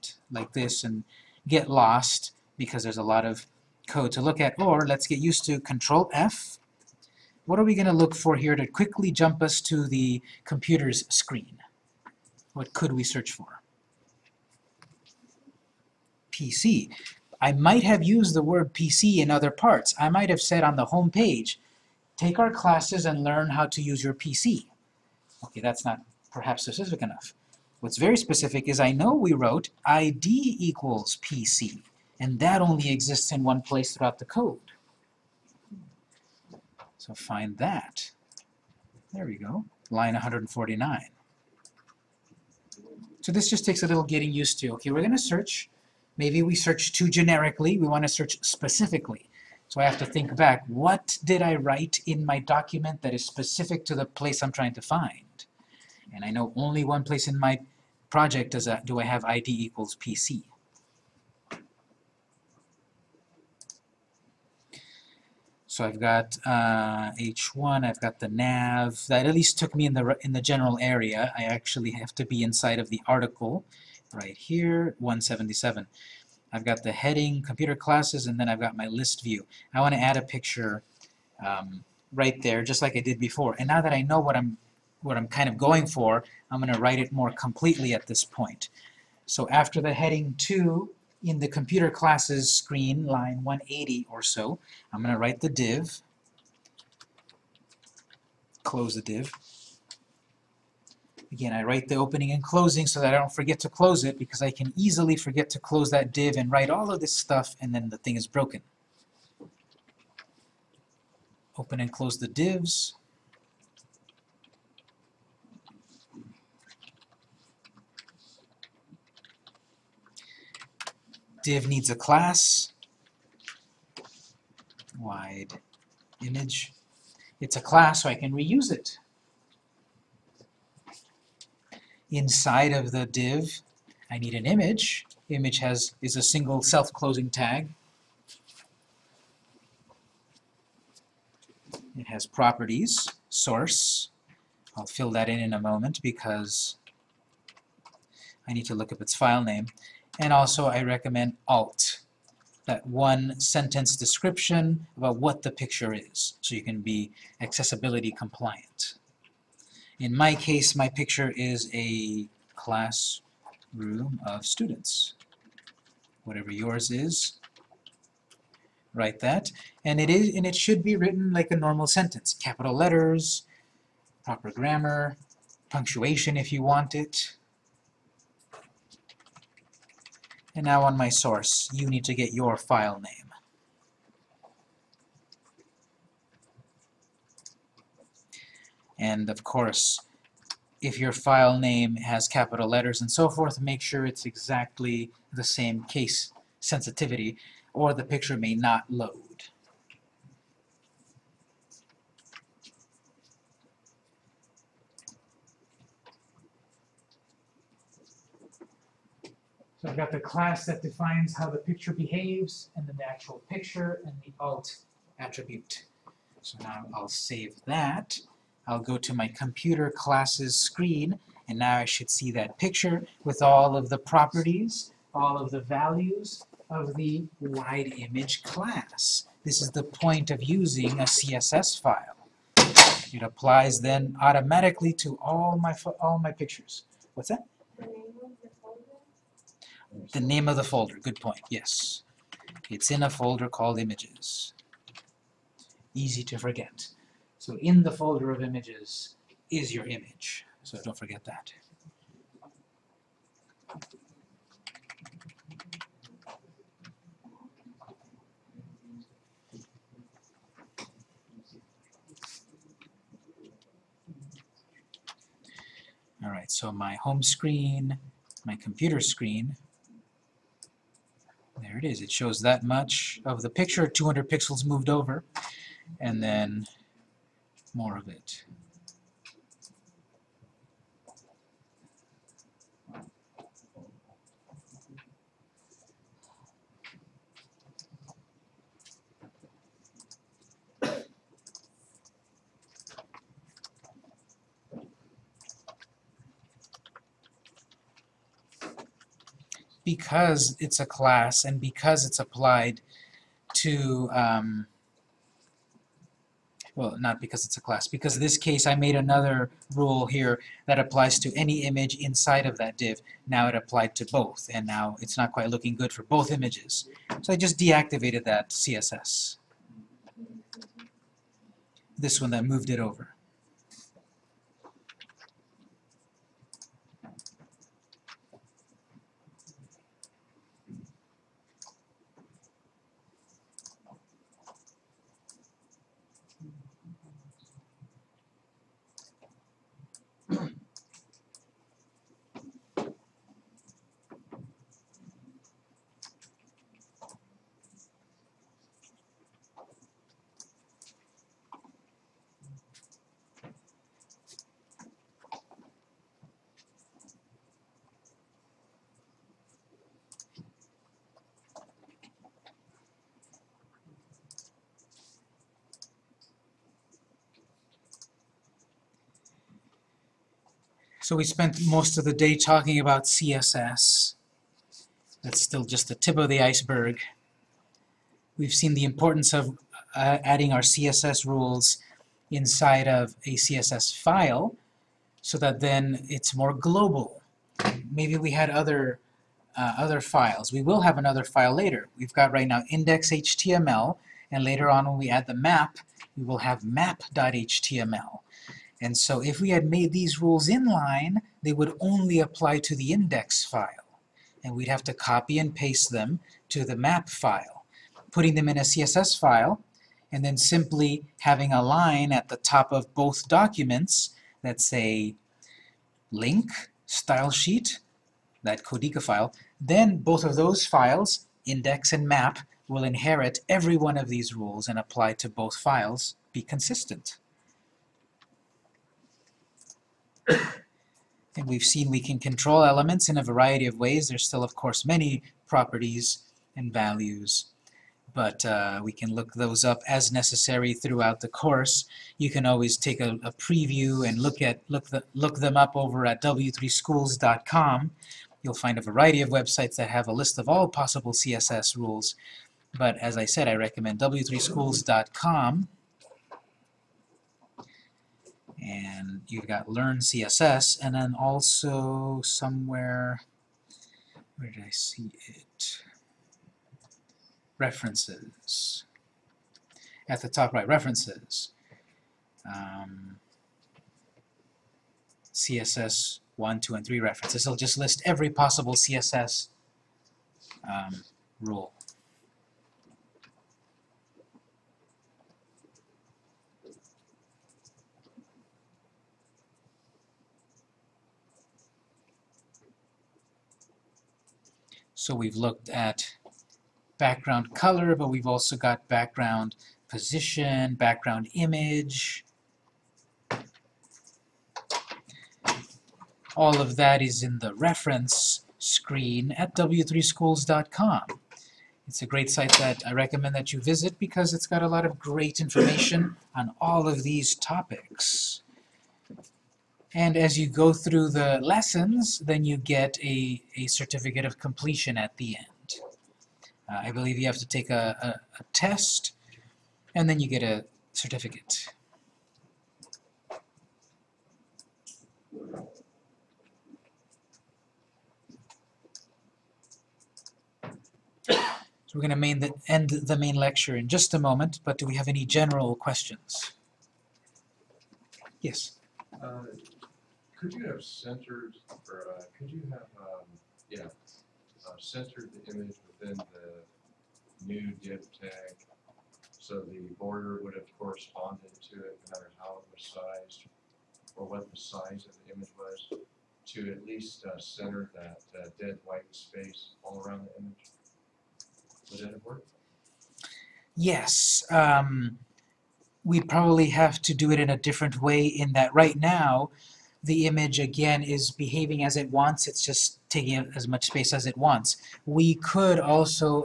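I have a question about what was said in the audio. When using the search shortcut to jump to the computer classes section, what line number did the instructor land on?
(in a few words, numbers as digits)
149.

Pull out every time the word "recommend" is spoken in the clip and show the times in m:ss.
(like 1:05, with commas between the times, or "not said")
2:30, 7:33, 8:32.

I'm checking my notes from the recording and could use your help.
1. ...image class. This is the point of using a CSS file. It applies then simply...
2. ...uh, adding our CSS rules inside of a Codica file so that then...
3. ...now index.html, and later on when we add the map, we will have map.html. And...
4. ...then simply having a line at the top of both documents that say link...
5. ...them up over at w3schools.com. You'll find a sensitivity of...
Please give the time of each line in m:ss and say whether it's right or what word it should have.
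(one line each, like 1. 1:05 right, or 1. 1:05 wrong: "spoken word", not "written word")
1. 3:47 wrong: "automatically", not "simply"
2. 6:19 wrong: "CSS", not "Codica"
3. 6:32 right
4. 6:50 right
5. 7:25 wrong: "variety", not "sensitivity".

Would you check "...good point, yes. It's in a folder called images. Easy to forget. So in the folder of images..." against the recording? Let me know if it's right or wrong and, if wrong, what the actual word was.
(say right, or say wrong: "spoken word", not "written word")
right.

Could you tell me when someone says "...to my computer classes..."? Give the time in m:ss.
3:38.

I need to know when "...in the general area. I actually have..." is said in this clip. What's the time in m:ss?
1:10.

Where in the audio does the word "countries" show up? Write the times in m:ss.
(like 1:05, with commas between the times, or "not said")
not said.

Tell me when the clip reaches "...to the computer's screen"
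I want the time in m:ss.
0:09.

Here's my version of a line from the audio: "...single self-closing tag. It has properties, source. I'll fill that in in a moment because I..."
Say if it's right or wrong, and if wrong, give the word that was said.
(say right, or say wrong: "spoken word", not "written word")
right.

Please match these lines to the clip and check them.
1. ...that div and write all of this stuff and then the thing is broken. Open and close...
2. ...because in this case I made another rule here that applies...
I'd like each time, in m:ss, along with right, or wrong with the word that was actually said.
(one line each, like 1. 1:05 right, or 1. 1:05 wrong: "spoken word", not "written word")
1. 1:45 right
2. 5:07 right.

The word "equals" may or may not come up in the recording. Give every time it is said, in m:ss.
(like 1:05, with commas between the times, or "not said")
0:30, 0:59.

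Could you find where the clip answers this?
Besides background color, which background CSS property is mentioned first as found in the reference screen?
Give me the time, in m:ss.
8:18.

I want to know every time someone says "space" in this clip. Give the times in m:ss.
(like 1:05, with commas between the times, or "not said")
9:29, 9:43.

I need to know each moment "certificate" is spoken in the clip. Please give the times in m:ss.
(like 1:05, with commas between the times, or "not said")
8:43, 8:50.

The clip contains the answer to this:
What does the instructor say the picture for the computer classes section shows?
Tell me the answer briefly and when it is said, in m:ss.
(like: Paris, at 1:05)
a classroom of students, at 2:41.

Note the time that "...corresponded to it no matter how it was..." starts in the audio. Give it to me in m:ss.
9:20.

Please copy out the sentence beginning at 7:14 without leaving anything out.
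There's still, of course, many properties and values, but uh, we can look those up as necessary throughout the course.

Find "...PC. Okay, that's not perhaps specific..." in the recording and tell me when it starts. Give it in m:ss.
0:24.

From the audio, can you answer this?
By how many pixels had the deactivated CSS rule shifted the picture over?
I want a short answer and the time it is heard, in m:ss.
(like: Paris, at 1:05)
200, at 4:33.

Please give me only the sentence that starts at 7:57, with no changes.
It'll just list every possible CSS um, rule.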